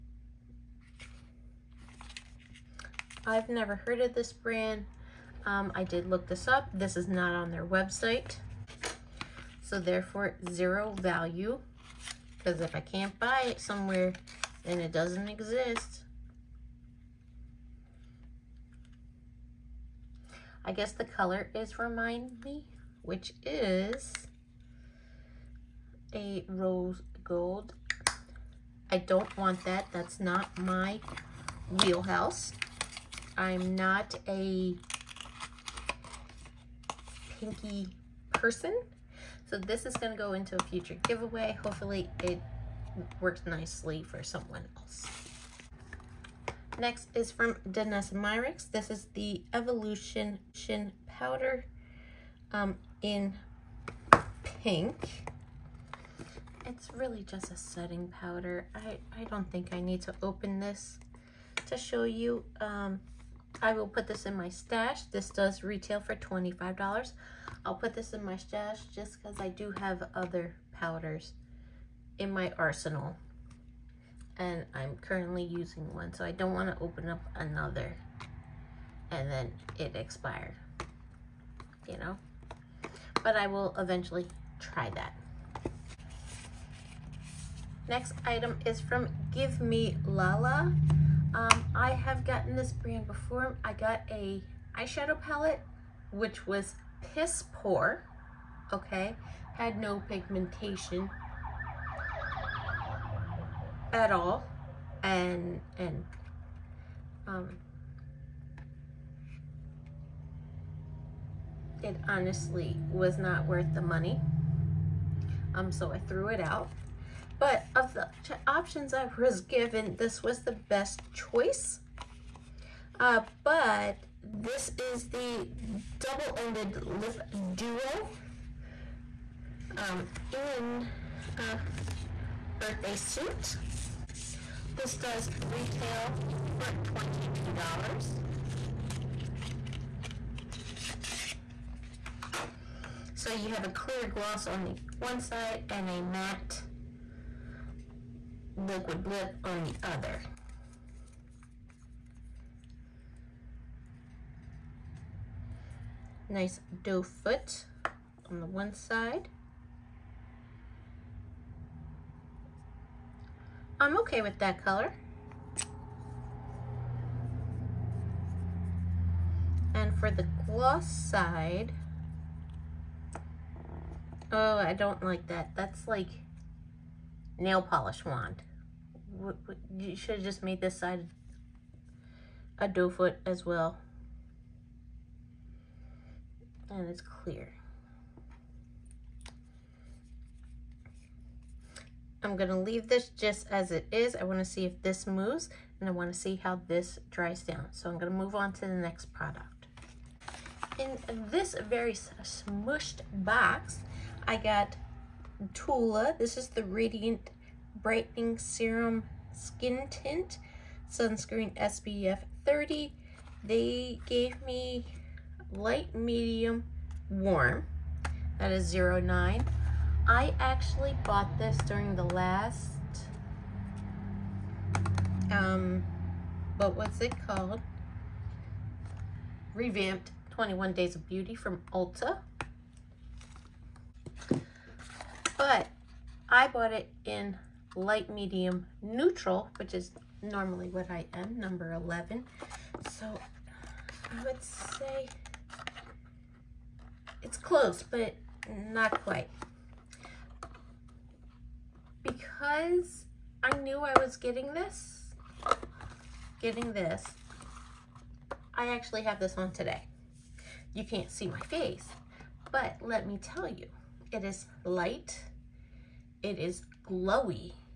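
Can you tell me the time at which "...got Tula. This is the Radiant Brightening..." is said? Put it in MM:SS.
03:24.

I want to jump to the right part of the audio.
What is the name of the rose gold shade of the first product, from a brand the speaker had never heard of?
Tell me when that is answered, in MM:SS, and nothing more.
00:21.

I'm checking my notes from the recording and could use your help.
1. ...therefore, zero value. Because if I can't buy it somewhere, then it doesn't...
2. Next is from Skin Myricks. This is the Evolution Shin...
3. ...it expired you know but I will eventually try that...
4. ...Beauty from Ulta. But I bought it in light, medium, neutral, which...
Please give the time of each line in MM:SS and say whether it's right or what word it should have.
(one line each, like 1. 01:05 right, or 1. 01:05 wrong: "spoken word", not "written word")
1. 00:09 right
2. 00:46 wrong: "Danessa", not "Skin"
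3. 01:19 right
4. 03:51 right.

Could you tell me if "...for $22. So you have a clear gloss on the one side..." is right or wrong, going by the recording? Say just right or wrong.
right.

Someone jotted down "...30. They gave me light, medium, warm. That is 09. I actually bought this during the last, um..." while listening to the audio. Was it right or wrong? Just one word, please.
right.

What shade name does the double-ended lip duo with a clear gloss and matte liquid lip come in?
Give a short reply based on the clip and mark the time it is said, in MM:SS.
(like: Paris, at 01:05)
Birthday Suit, at 02:12.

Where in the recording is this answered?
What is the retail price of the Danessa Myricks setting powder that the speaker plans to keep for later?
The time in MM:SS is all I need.
01:06.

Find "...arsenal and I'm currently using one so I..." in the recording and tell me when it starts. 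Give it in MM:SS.
01:12.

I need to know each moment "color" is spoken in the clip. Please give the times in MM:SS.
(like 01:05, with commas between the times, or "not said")
00:21, 02:44.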